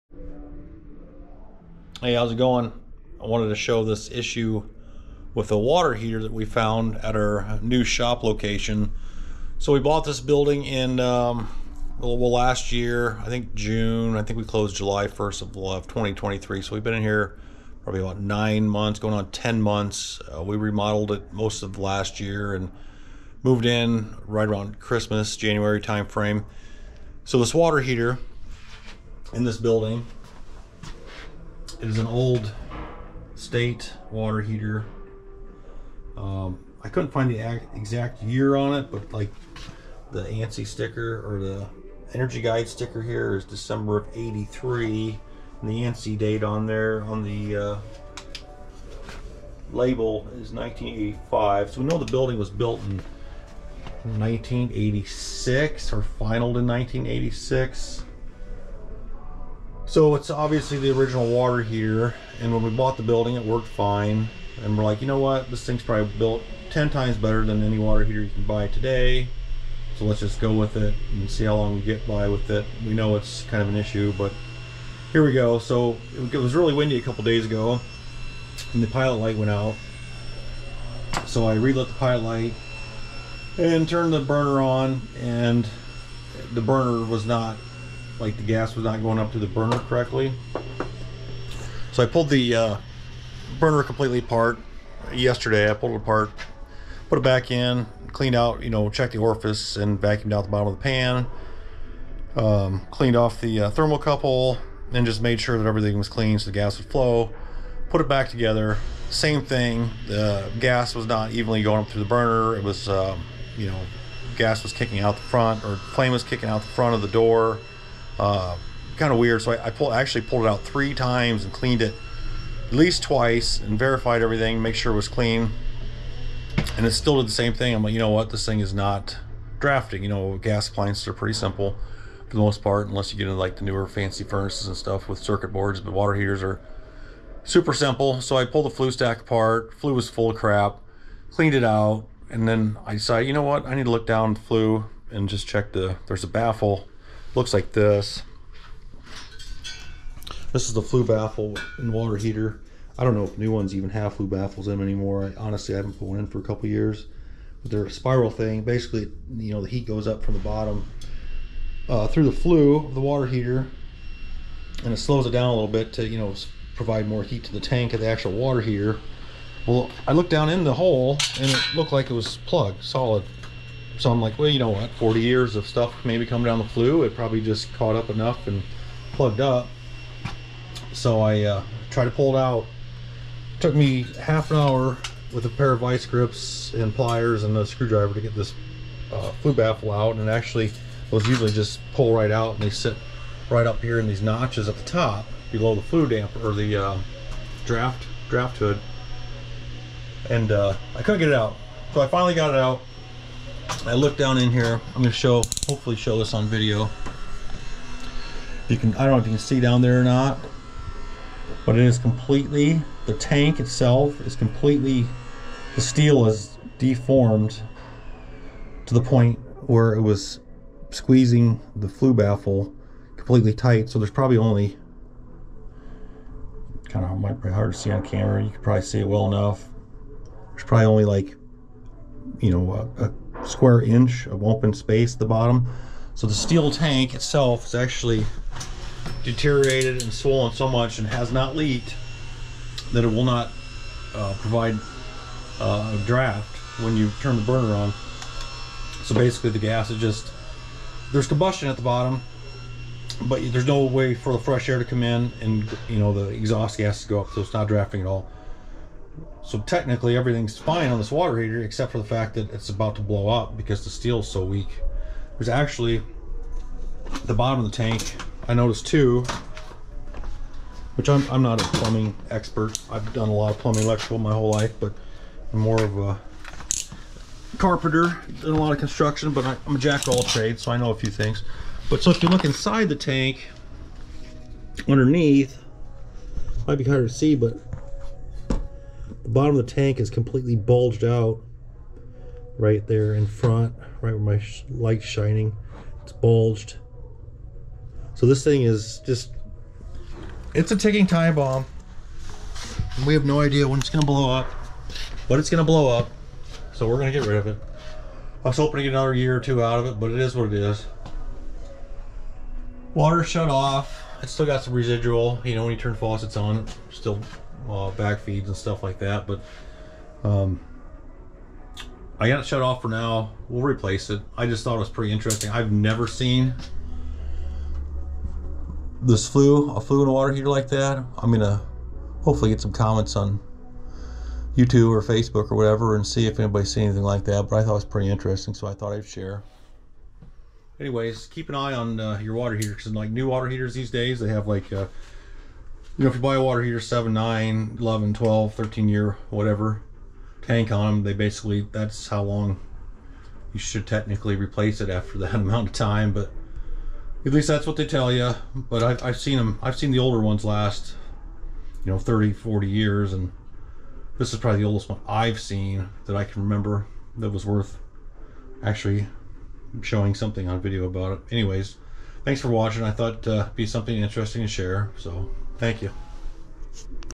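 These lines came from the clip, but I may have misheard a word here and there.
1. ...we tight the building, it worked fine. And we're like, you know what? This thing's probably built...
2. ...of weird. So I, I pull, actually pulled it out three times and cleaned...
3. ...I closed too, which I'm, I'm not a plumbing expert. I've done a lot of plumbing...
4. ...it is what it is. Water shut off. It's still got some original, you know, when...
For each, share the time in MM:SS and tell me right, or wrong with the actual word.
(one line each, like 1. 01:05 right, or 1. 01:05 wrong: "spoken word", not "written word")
1. 01:02 wrong: "bought", not "tight"
2. 01:59 right
3. 04:28 wrong: "noticed", not "closed"
4. 05:10 wrong: "residual", not "original".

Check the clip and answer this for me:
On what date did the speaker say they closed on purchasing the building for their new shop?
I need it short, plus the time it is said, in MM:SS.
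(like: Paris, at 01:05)
July 1st, 2023, at 00:14.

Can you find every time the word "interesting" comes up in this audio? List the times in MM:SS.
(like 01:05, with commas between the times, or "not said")
05:25, 05:38, 06:13.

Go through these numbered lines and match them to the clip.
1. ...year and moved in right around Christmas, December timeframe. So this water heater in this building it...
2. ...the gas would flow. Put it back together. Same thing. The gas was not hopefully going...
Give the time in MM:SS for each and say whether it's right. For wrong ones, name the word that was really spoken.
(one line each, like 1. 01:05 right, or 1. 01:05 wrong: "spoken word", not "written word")
1. 00:22 wrong: "January", not "December"
2. 01:46 wrong: "evenly", not "hopefully".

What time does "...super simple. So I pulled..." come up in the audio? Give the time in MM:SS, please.
02:17.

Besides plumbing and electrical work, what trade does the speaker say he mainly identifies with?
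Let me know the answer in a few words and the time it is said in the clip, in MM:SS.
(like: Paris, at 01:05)
Carpenter, at 04:37.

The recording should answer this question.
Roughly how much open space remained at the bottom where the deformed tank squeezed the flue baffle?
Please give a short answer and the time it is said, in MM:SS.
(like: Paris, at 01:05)
1 square inch, at 03:53.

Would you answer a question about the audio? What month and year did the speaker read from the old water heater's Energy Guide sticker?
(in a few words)
December 1983.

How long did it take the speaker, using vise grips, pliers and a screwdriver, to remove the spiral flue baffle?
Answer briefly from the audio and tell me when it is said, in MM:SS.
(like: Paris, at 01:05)
Half an hour, at 03:04.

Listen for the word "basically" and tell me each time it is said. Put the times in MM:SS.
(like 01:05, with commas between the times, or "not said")
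02:38, 04:09, 05:51.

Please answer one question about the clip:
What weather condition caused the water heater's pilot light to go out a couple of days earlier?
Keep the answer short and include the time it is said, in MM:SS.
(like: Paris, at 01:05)
Windy, at 01:16.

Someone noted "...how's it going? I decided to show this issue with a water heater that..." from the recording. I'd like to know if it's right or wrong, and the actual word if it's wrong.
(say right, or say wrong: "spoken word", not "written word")
wrong: "wanted", not "decided".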